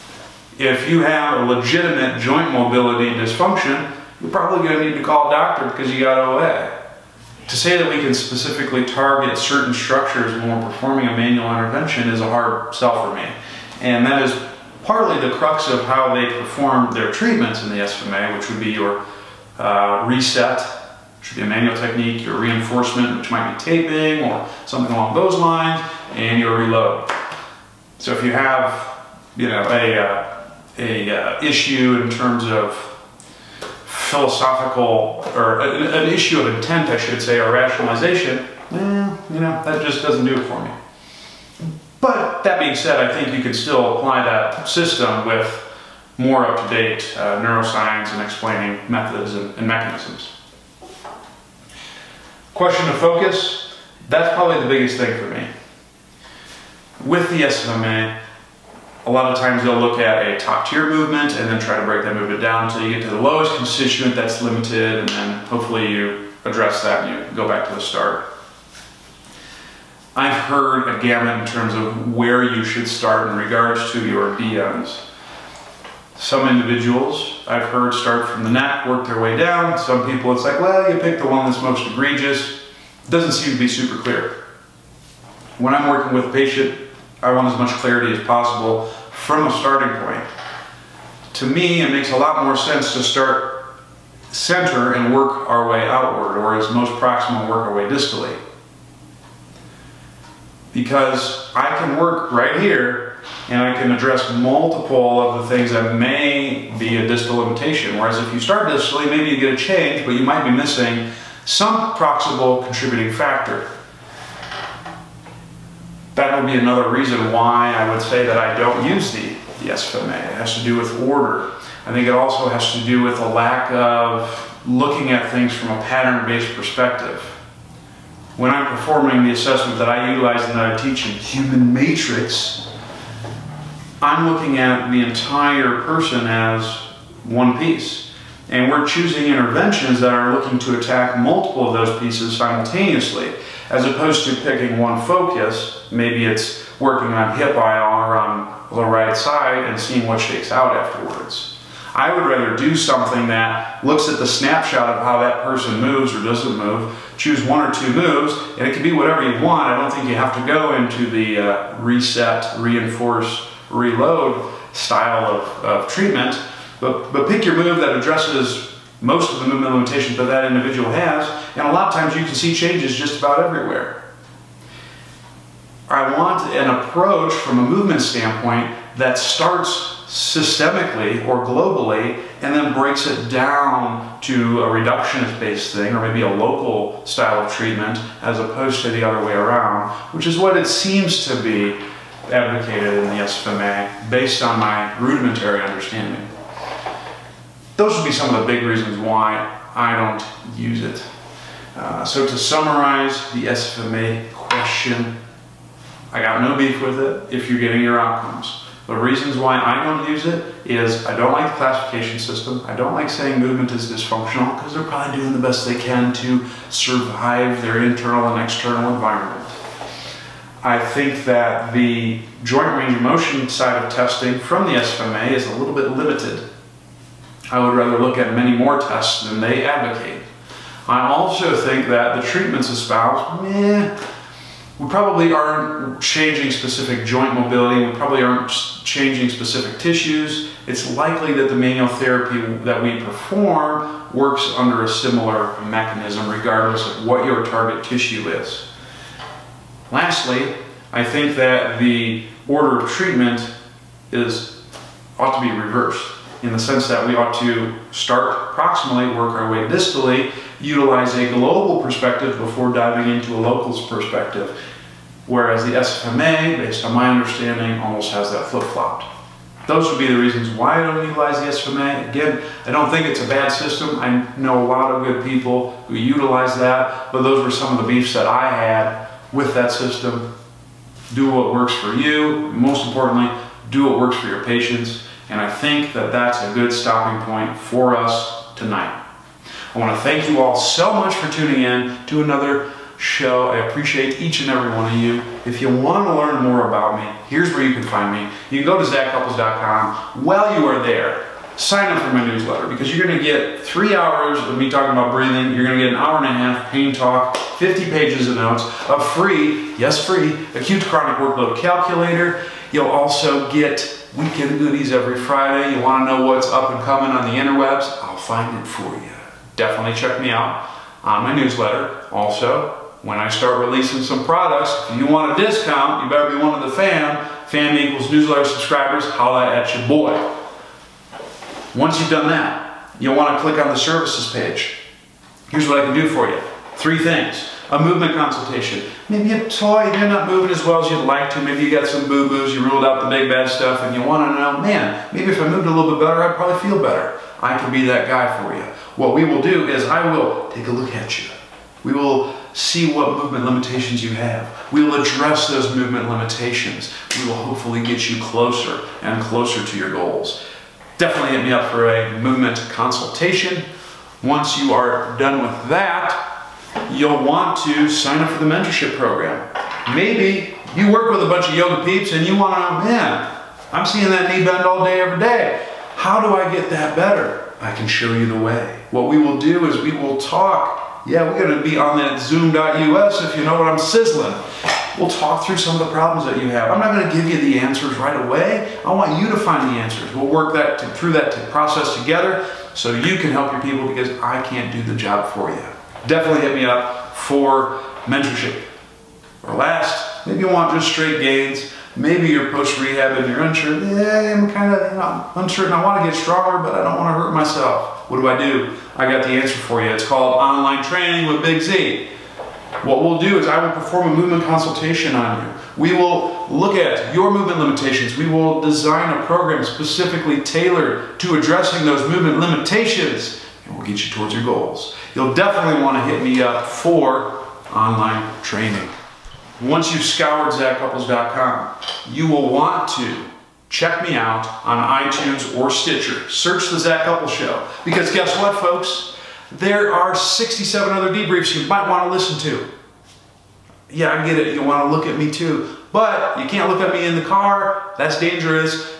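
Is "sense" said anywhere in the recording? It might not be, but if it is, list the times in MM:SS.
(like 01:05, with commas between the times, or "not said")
01:32, 04:16.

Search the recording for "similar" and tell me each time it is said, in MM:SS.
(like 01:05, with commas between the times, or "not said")
04:04.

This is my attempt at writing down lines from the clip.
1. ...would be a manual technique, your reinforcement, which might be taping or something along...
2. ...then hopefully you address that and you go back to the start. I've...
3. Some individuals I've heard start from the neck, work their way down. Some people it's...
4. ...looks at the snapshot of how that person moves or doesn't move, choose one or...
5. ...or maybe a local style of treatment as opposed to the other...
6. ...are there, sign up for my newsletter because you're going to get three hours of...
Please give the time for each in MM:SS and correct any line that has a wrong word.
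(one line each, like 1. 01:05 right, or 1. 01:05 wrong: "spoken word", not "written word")
1. 00:21 right
2. 01:05 right
3. 01:16 right
4. 02:33 right
5. 03:05 right
6. 05:00 right.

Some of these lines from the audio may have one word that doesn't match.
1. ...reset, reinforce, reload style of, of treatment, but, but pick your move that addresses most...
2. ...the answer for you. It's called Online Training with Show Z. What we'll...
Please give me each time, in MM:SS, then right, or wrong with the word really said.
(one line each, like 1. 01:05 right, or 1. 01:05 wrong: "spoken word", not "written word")
1. 02:41 right
2. 06:49 wrong: "Big", not "Show".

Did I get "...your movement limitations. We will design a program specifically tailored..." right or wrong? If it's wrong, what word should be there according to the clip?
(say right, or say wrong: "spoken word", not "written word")
right.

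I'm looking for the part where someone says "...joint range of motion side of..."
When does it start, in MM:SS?
03:42.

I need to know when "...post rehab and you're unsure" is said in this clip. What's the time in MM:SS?
06:42.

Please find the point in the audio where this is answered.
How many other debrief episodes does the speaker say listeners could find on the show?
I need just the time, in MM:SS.
07:20.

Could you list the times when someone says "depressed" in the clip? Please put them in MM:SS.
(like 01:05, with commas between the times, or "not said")
not said.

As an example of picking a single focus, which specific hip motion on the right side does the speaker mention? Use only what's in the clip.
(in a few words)
hip IR.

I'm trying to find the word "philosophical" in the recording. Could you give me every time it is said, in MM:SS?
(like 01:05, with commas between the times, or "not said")
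00:34.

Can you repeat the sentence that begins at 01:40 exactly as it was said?
Because I can work right here, and I can address multiple of the things that may be a distal limitation.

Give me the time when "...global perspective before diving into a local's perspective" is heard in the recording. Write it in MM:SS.
04:21.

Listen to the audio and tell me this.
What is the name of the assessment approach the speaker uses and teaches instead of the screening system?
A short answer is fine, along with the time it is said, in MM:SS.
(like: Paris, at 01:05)
Human Matrix, at 02:11.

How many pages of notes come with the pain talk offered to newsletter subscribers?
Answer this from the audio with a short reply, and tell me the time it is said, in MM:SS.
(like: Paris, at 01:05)
50, at 05:07.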